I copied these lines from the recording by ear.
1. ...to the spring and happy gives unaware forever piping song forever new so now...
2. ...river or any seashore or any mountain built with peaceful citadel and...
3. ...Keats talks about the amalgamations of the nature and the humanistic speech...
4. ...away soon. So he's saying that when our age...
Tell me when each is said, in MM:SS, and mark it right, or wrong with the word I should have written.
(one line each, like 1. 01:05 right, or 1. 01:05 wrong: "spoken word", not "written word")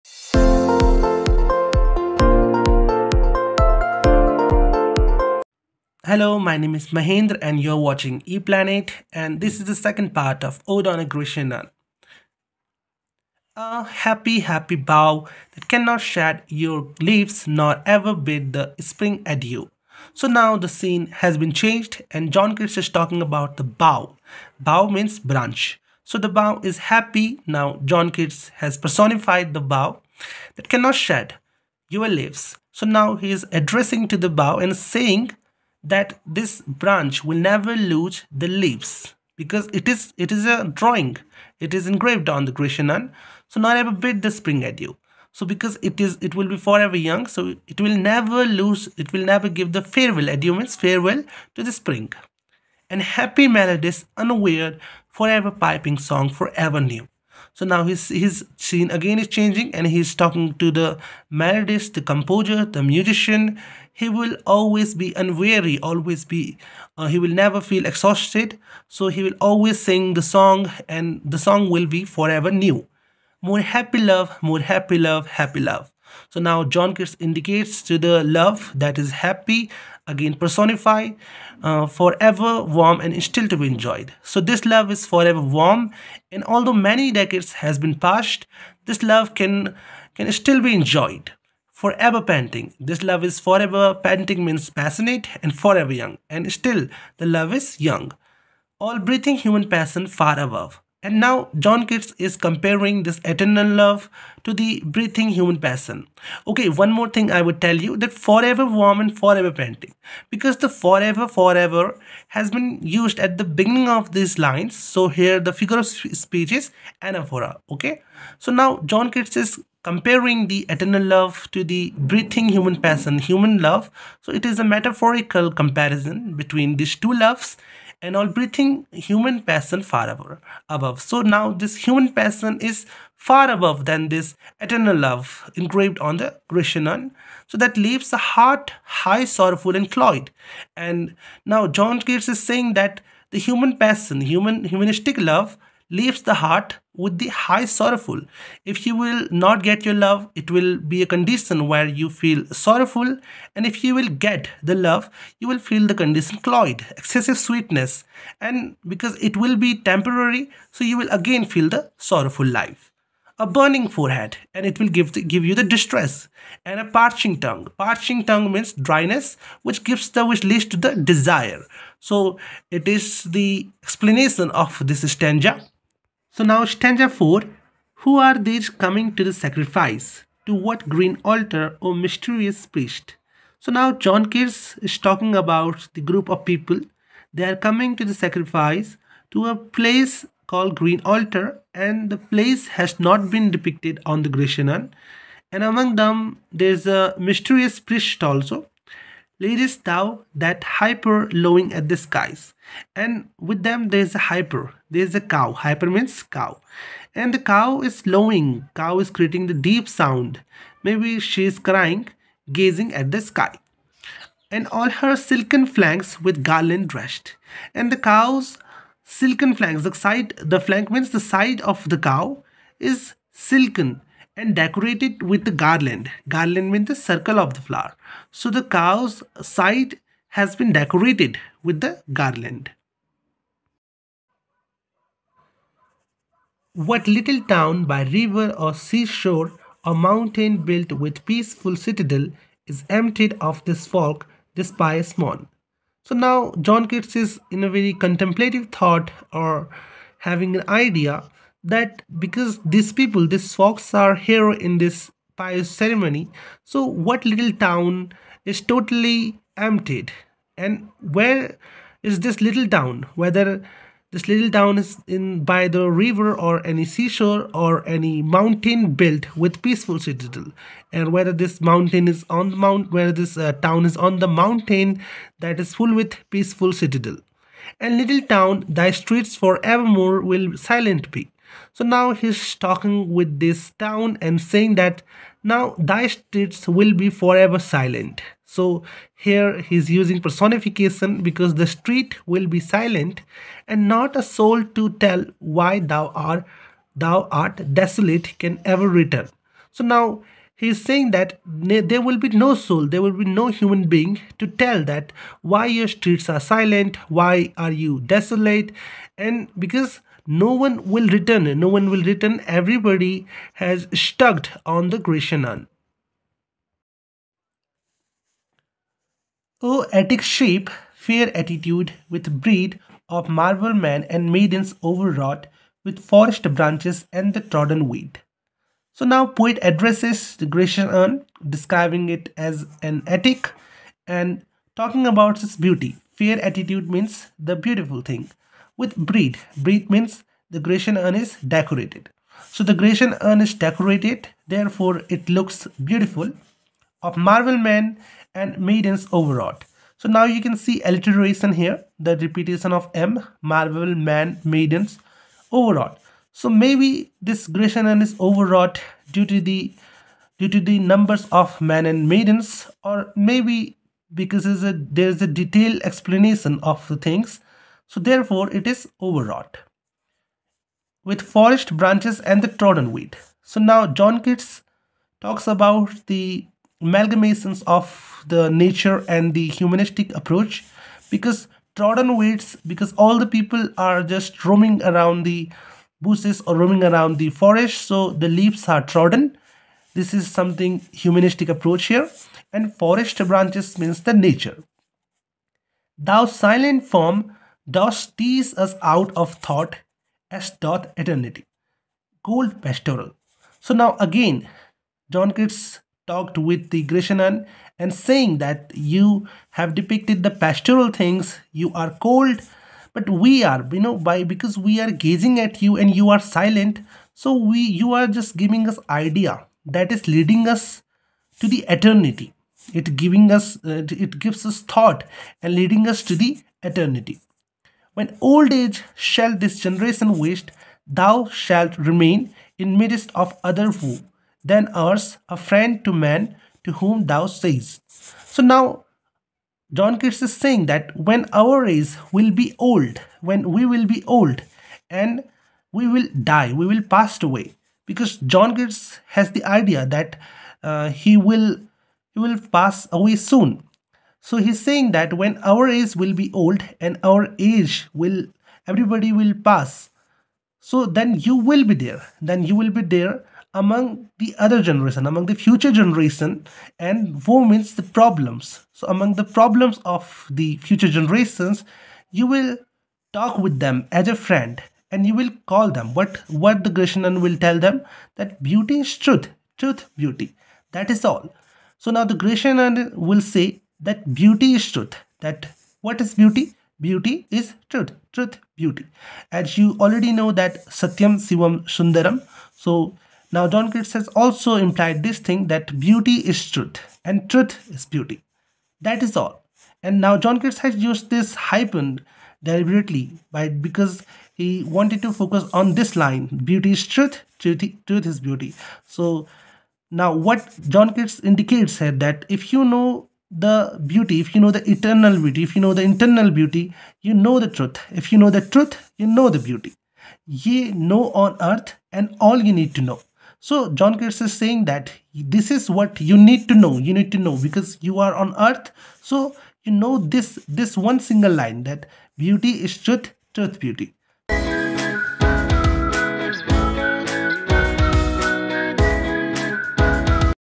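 1. 00:51 wrong: "melodies", not "gives"
2. 04:25 right
3. 06:14 wrong: "approach", not "speech"
4. 07:32 right.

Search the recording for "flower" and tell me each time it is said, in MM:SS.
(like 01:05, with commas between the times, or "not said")
03:47.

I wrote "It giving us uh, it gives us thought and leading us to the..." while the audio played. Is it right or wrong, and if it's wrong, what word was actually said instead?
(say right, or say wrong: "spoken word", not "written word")
right.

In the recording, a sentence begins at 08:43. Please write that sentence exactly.
So John Keats is saying that this is what you need to know.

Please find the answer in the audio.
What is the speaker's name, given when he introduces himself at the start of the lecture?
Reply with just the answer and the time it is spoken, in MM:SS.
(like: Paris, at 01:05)
Mahendra, at 00:06.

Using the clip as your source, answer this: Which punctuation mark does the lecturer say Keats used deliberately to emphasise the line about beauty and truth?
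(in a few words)
Hyphen.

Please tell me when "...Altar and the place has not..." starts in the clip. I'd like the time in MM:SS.
03:11.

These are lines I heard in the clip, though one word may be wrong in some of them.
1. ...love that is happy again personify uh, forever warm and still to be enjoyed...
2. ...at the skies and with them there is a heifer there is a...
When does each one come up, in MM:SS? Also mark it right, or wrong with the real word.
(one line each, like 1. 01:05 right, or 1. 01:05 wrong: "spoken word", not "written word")
1. 01:18 right
2. 03:21 right.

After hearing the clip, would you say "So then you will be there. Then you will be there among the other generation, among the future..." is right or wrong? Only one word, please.
right.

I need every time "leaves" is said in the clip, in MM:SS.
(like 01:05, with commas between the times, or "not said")
00:16, 00:32, 00:38, 02:17, 02:25, 06:28.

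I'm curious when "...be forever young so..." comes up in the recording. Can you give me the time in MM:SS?
00:46.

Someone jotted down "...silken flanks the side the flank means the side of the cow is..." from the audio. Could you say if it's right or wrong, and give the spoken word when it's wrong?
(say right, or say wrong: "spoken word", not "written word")
right.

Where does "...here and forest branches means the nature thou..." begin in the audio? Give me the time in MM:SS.
06:31.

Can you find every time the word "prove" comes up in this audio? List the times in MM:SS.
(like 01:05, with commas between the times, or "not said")
not said.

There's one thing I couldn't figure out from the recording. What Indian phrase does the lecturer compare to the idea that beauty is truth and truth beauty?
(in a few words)
Satyam Sivam Sundaram.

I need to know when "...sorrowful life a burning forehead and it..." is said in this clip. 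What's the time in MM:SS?
02:41.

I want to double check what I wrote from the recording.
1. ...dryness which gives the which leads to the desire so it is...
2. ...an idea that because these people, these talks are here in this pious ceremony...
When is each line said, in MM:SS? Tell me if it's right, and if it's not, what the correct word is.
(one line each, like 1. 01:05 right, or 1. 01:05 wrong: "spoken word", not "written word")
1. 02:48 right
2. 04:10 wrong: "folks", not "talks".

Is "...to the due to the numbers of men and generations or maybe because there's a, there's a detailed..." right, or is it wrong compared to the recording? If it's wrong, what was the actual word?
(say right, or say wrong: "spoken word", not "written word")
wrong: "maidens", not "generations".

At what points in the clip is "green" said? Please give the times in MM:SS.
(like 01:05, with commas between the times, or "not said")
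03:00, 03:10.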